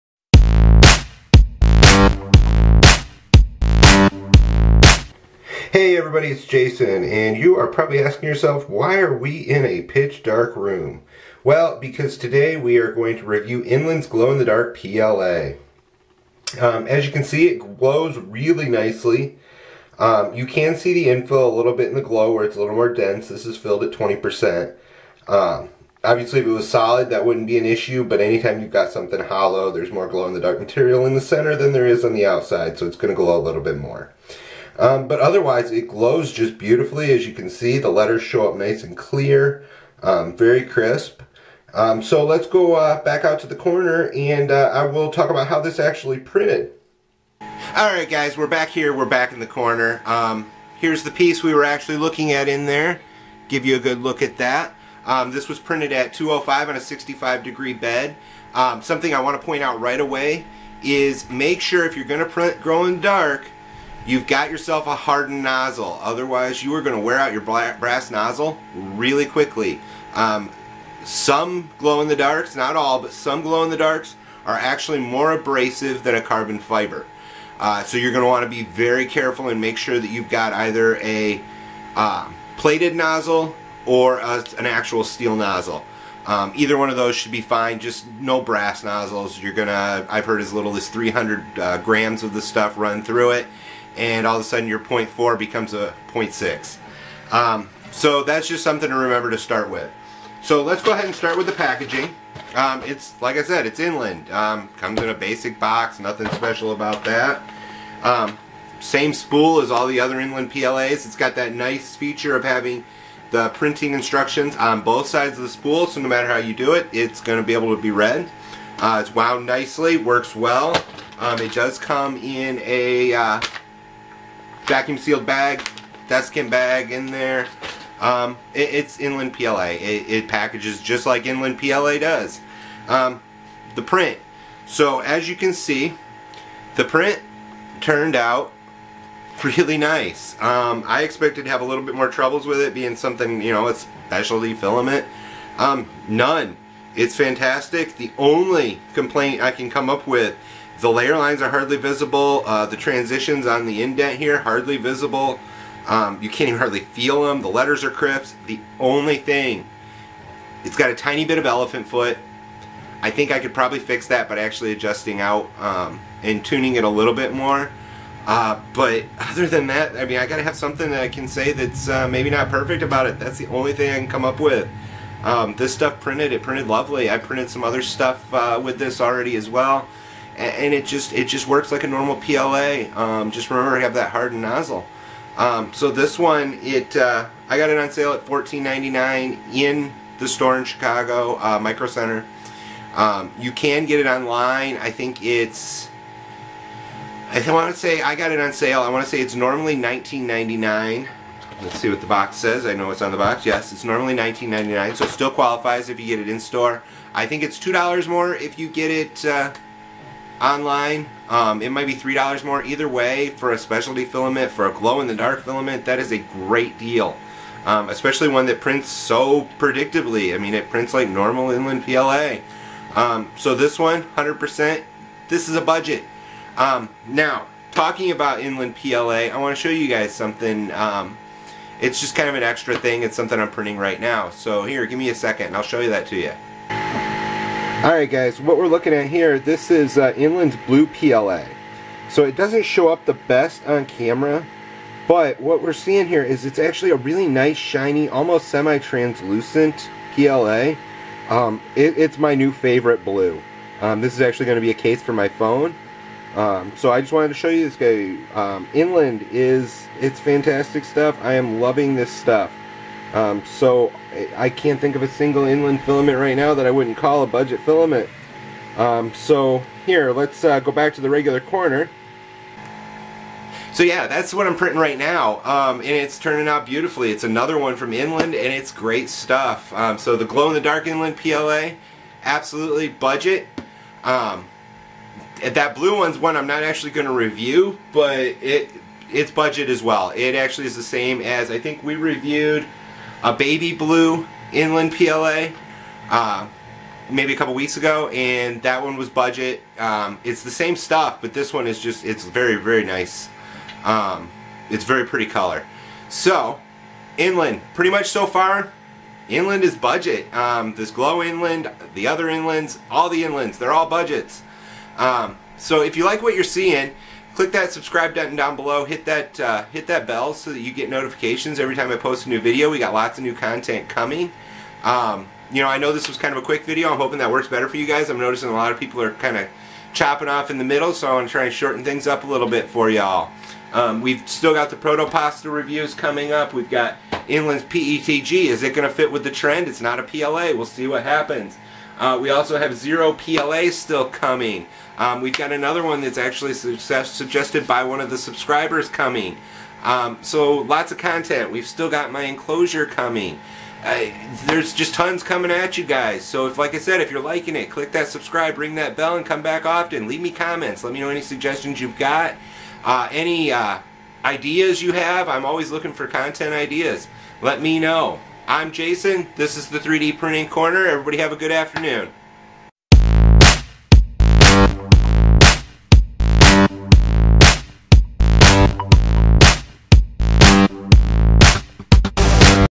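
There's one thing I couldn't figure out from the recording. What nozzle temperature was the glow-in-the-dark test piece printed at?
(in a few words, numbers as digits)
205.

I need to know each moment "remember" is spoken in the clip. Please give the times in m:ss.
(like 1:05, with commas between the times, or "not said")
1:38, 3:03.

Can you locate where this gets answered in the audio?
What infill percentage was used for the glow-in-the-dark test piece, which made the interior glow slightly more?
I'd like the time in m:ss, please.
0:23.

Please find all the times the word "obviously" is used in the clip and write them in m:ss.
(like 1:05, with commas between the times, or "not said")
0:26.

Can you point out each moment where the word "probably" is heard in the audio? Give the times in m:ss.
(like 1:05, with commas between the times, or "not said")
0:07, 2:43.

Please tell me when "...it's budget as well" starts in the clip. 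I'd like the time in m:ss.
4:49.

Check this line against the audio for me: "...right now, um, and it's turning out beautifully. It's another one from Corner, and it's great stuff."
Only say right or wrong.
wrong.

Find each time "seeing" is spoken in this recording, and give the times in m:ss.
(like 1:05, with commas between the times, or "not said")
4:05, 5:16.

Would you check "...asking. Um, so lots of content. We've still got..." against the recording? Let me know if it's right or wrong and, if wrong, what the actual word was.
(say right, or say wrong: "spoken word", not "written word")
wrong: "coming", not "asking".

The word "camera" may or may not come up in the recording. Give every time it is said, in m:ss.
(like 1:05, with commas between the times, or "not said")
4:03.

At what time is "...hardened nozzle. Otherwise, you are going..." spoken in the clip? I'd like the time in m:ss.
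1:04.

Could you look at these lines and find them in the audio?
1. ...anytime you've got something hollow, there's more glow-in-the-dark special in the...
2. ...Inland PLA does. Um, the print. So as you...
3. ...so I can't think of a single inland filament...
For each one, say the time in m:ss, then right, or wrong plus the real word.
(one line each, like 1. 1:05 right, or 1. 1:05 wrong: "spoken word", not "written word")
1. 0:28 wrong: "material", not "special"
2. 2:11 right
3. 4:23 right.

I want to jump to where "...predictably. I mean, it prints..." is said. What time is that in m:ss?
3:39.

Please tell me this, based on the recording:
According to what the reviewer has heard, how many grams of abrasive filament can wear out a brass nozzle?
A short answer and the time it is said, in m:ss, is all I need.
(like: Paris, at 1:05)
300 grams, at 1:30.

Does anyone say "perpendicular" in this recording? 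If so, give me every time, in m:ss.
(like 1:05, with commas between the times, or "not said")
not said.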